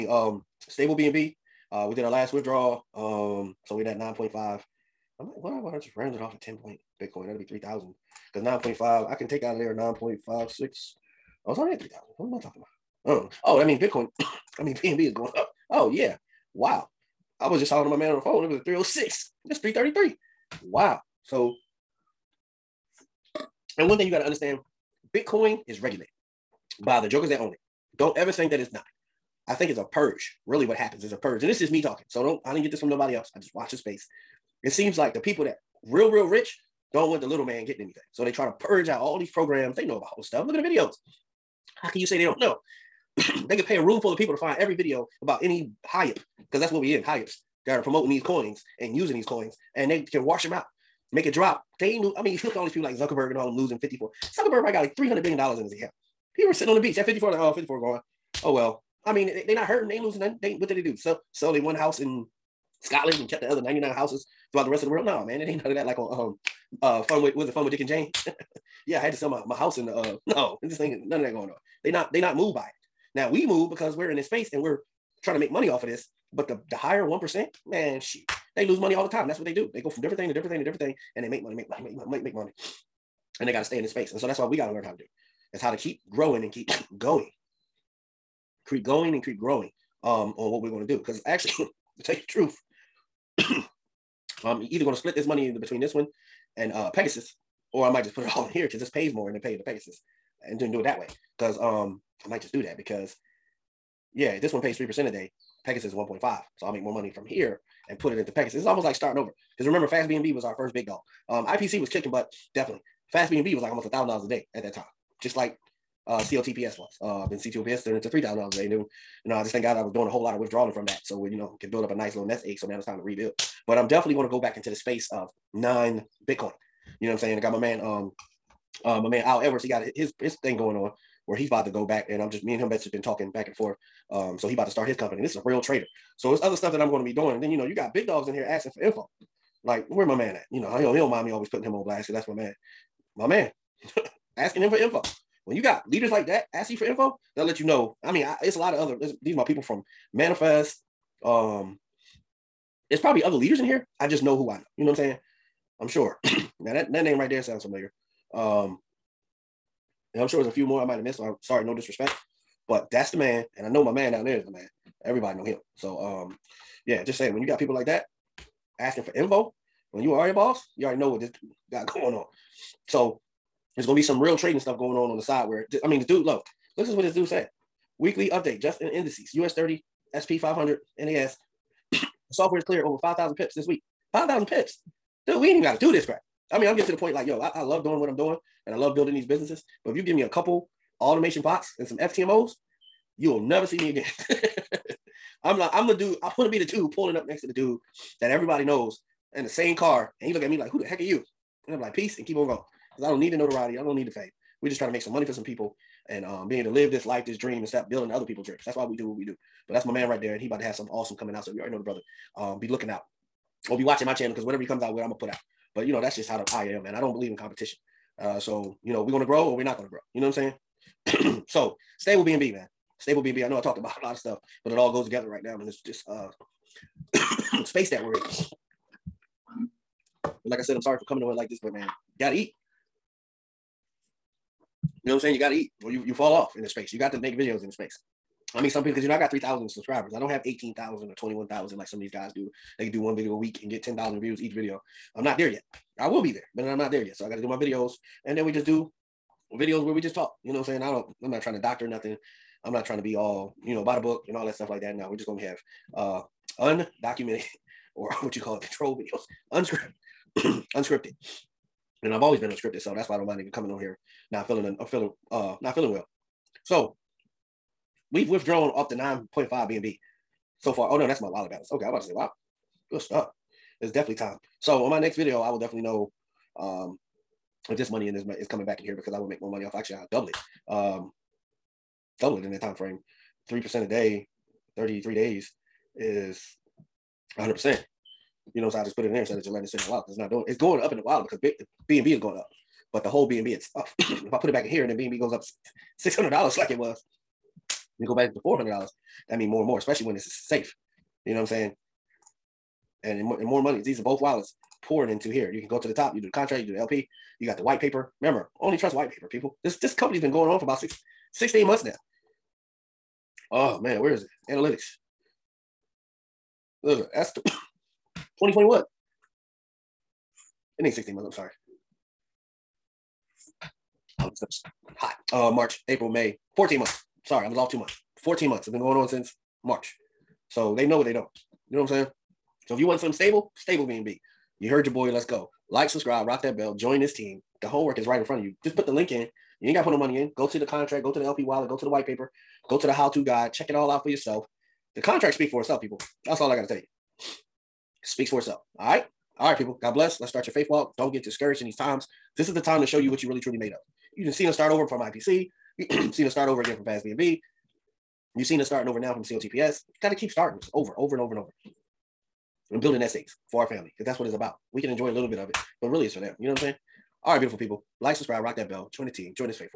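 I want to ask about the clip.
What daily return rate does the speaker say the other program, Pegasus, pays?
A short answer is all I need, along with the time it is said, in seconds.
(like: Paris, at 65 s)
1.5%, at 105 s.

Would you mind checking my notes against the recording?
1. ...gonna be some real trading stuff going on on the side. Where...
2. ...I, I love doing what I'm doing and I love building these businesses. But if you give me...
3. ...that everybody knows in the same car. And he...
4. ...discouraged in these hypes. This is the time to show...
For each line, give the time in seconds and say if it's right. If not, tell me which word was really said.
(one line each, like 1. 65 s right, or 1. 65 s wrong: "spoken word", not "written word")
1. 173 s right
2. 187 s right
3. 198 s right
4. 351 s wrong: "times", not "hypes".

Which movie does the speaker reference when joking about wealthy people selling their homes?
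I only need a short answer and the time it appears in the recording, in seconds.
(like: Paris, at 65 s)
Fun with Dick and Jane, at 67 s.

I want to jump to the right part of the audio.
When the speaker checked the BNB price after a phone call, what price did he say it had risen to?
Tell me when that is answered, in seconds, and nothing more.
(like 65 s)
19 s.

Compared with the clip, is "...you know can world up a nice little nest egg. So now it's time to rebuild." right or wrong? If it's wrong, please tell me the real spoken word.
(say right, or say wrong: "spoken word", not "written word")
wrong: "build", not "world".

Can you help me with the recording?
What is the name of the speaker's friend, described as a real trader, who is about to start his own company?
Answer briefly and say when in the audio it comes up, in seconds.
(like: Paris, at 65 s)
Al Edwards, at 129 s.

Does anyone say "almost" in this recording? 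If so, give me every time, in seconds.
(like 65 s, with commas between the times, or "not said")
108 s, 113 s.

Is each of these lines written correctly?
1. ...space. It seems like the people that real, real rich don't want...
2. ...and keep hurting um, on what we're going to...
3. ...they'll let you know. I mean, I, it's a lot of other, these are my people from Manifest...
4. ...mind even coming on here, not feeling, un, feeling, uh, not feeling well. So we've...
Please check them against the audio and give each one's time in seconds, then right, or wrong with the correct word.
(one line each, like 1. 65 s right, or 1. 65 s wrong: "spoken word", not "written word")
1. 33 s right
2. 89 s wrong: "growing", not "hurting"
3. 147 s right
4. 263 s right.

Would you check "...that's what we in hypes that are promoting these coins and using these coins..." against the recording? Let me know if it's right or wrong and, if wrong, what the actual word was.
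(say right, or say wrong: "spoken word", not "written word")
right.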